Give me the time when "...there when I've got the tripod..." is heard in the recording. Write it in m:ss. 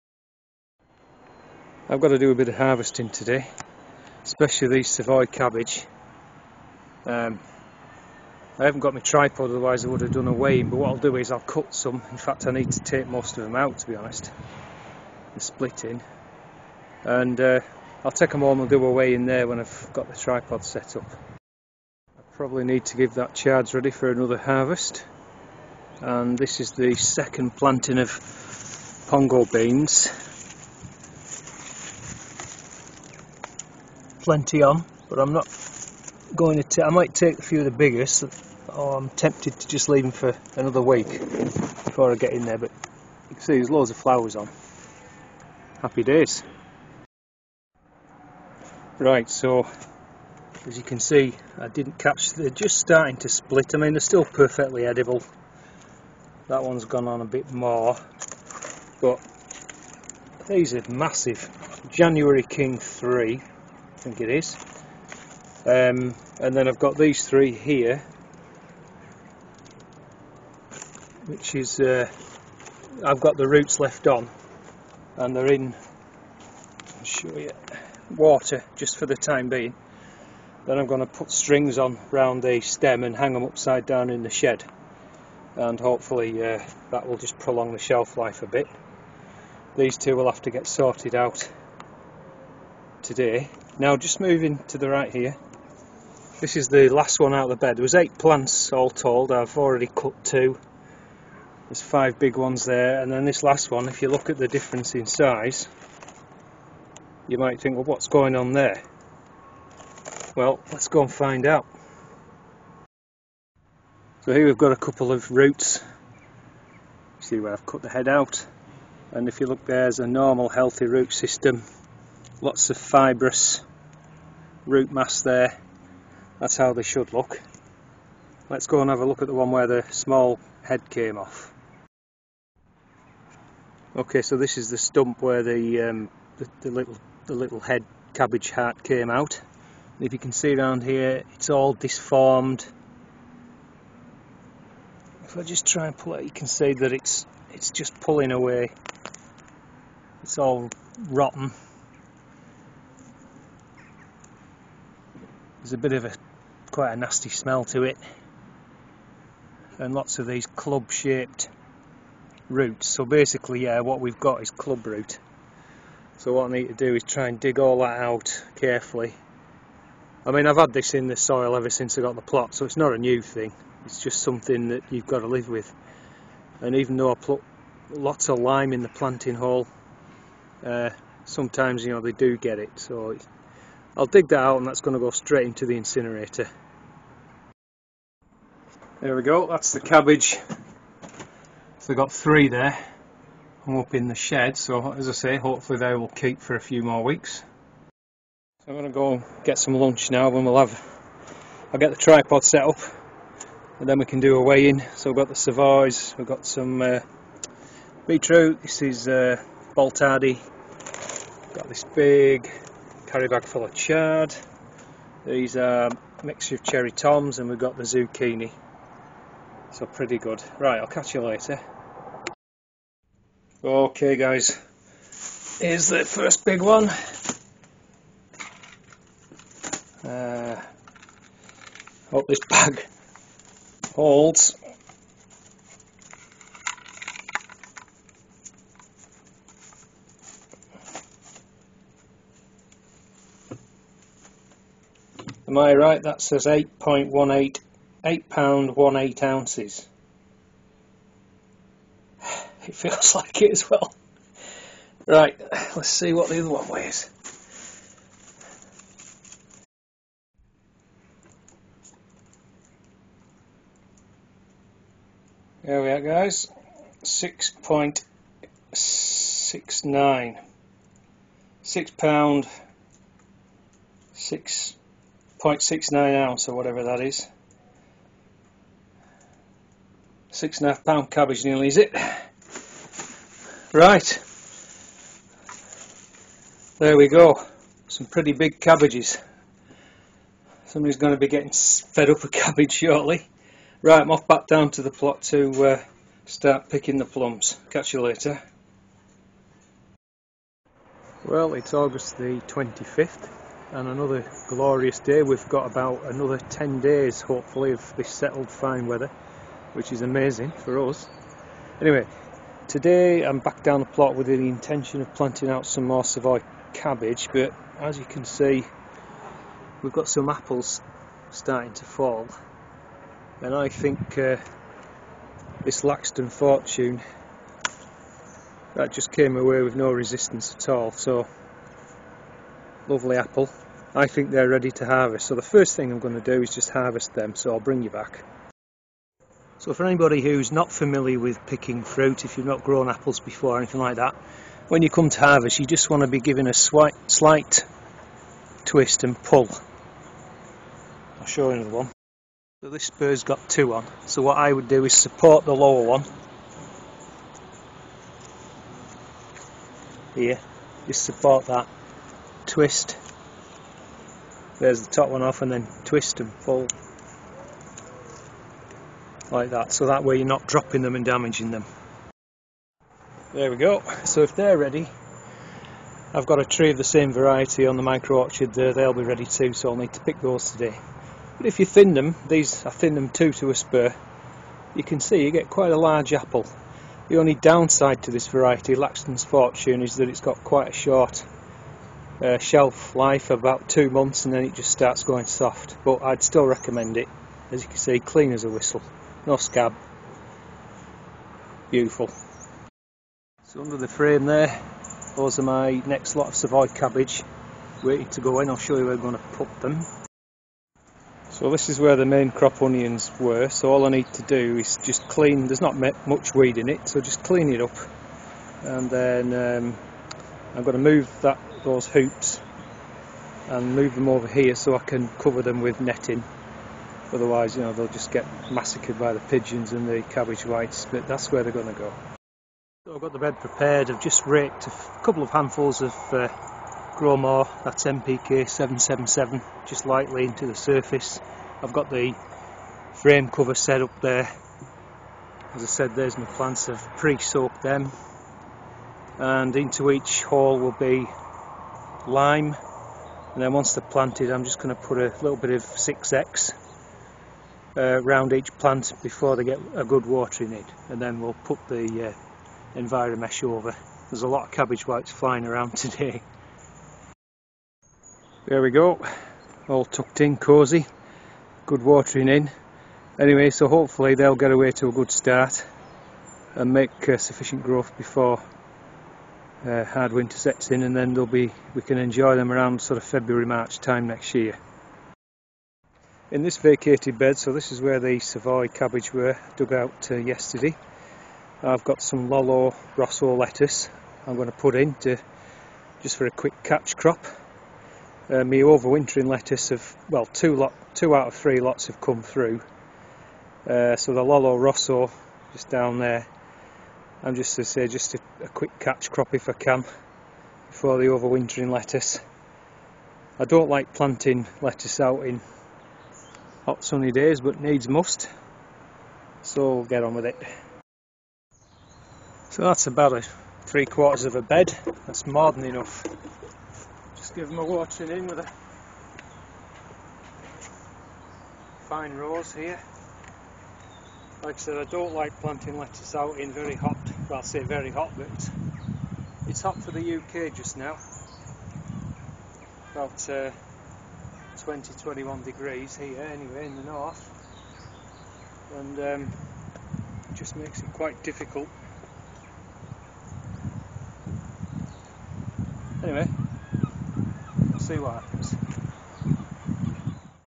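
0:19.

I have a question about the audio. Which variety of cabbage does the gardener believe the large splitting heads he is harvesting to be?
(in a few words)
January King 3.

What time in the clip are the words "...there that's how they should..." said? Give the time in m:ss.
2:05.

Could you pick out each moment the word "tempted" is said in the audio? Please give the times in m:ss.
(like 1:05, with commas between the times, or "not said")
0:39.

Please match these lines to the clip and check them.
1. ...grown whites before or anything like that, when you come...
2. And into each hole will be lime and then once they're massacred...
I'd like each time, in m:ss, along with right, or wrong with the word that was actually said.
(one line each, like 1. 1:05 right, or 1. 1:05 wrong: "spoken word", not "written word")
1. 5:42 wrong: "apples", not "whites"
2. 7:29 wrong: "planted", not "massacred".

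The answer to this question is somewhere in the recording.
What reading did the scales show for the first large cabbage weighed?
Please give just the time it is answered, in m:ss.
4:06.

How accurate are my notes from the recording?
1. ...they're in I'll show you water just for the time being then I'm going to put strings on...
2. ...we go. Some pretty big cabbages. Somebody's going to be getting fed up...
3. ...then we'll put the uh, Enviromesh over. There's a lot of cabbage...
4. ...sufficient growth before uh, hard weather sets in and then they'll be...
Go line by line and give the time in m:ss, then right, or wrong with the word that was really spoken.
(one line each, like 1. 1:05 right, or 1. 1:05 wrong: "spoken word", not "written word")
1. 1:15 right
2. 4:46 right
3. 7:41 right
4. 7:57 wrong: "winter", not "weather".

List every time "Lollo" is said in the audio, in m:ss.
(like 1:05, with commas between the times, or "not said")
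8:12, 8:24.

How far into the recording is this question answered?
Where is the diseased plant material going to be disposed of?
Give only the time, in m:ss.
3:05.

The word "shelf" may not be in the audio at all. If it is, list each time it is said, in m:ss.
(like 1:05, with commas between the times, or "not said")
1:27, 6:32.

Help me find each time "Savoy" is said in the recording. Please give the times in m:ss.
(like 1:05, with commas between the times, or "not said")
0:04, 3:25, 5:16, 6:46, 8:08.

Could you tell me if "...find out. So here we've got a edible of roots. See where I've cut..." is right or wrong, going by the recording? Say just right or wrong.
wrong.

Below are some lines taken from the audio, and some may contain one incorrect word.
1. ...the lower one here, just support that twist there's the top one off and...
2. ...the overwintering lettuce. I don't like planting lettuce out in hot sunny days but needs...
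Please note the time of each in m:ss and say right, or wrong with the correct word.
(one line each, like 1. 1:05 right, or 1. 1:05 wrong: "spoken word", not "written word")
1. 5:55 right
2. 8:30 right.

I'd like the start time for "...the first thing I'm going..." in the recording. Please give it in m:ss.
5:35.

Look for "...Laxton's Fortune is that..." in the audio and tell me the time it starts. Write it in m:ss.
6:28.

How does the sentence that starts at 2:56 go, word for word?
And even though I put lots of lime in the planting hole, uh, sometimes you know they do get it.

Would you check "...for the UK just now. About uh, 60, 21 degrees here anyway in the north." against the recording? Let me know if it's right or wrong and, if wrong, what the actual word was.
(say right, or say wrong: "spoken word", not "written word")
wrong: "20", not "60".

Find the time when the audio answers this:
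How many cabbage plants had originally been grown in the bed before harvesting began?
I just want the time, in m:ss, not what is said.
1:37.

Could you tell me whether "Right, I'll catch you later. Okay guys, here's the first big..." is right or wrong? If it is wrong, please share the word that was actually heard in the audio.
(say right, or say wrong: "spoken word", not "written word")
right.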